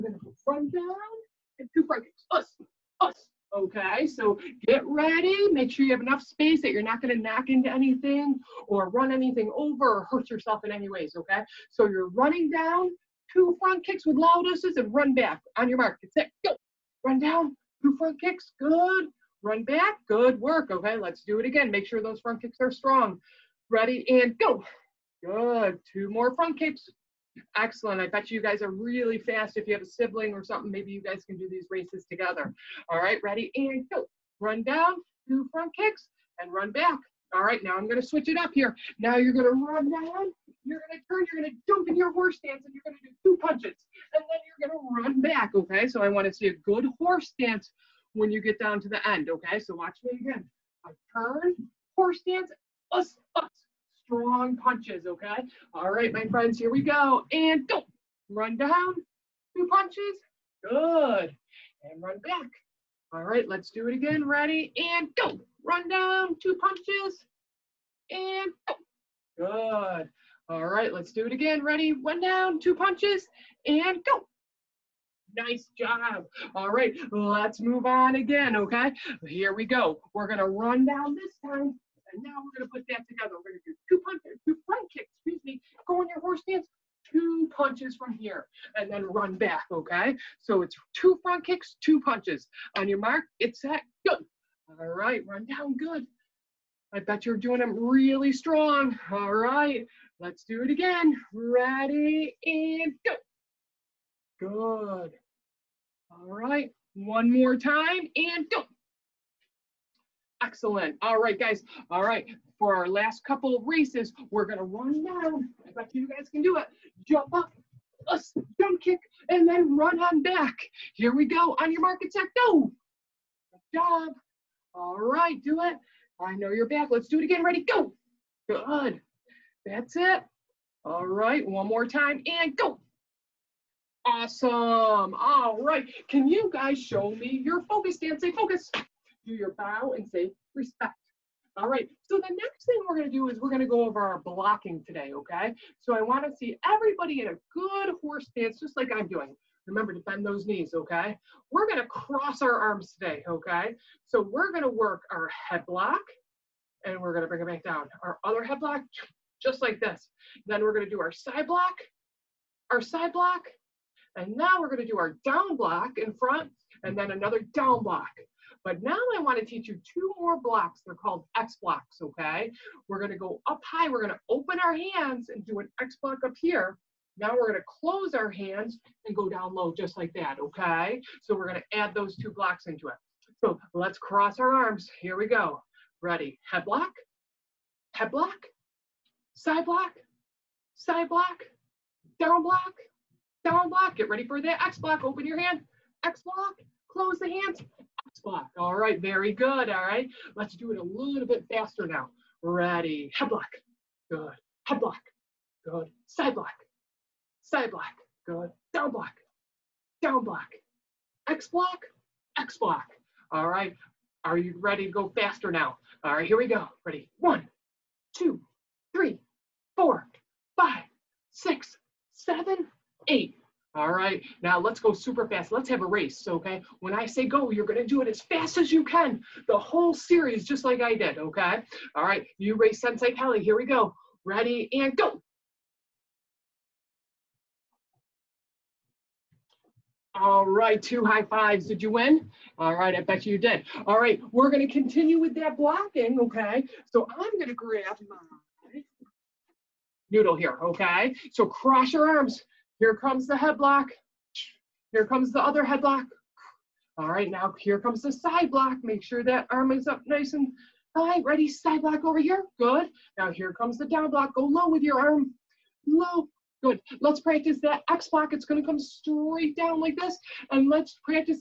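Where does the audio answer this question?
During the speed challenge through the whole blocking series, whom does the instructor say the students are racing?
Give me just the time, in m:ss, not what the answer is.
3:52.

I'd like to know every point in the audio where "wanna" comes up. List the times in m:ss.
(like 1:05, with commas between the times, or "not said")
2:26, 2:49.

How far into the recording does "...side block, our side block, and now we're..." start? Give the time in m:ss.
2:41.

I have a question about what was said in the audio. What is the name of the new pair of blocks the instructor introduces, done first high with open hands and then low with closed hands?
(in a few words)
X blocks.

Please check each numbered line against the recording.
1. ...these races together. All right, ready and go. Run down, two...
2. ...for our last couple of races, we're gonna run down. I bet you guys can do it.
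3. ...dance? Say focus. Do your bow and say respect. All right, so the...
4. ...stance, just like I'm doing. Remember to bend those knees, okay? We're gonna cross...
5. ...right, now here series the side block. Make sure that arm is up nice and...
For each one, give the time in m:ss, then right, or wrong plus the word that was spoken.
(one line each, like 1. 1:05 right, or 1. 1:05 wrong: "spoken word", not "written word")
1. 0:31 right
2. 1:52 right
3. 2:17 right
4. 2:28 right
5. 4:17 wrong: "comes", not "series".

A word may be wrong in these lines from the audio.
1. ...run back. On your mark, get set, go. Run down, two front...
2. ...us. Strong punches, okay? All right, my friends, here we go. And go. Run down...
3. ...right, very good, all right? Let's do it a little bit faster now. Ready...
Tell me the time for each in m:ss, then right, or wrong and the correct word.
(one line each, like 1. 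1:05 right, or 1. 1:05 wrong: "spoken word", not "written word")
1. 0:14 right
2. 0:53 right
3. 3:18 right.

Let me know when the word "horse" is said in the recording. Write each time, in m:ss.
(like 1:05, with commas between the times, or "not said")
0:42, 0:46, 0:51, 1:26, 2:27.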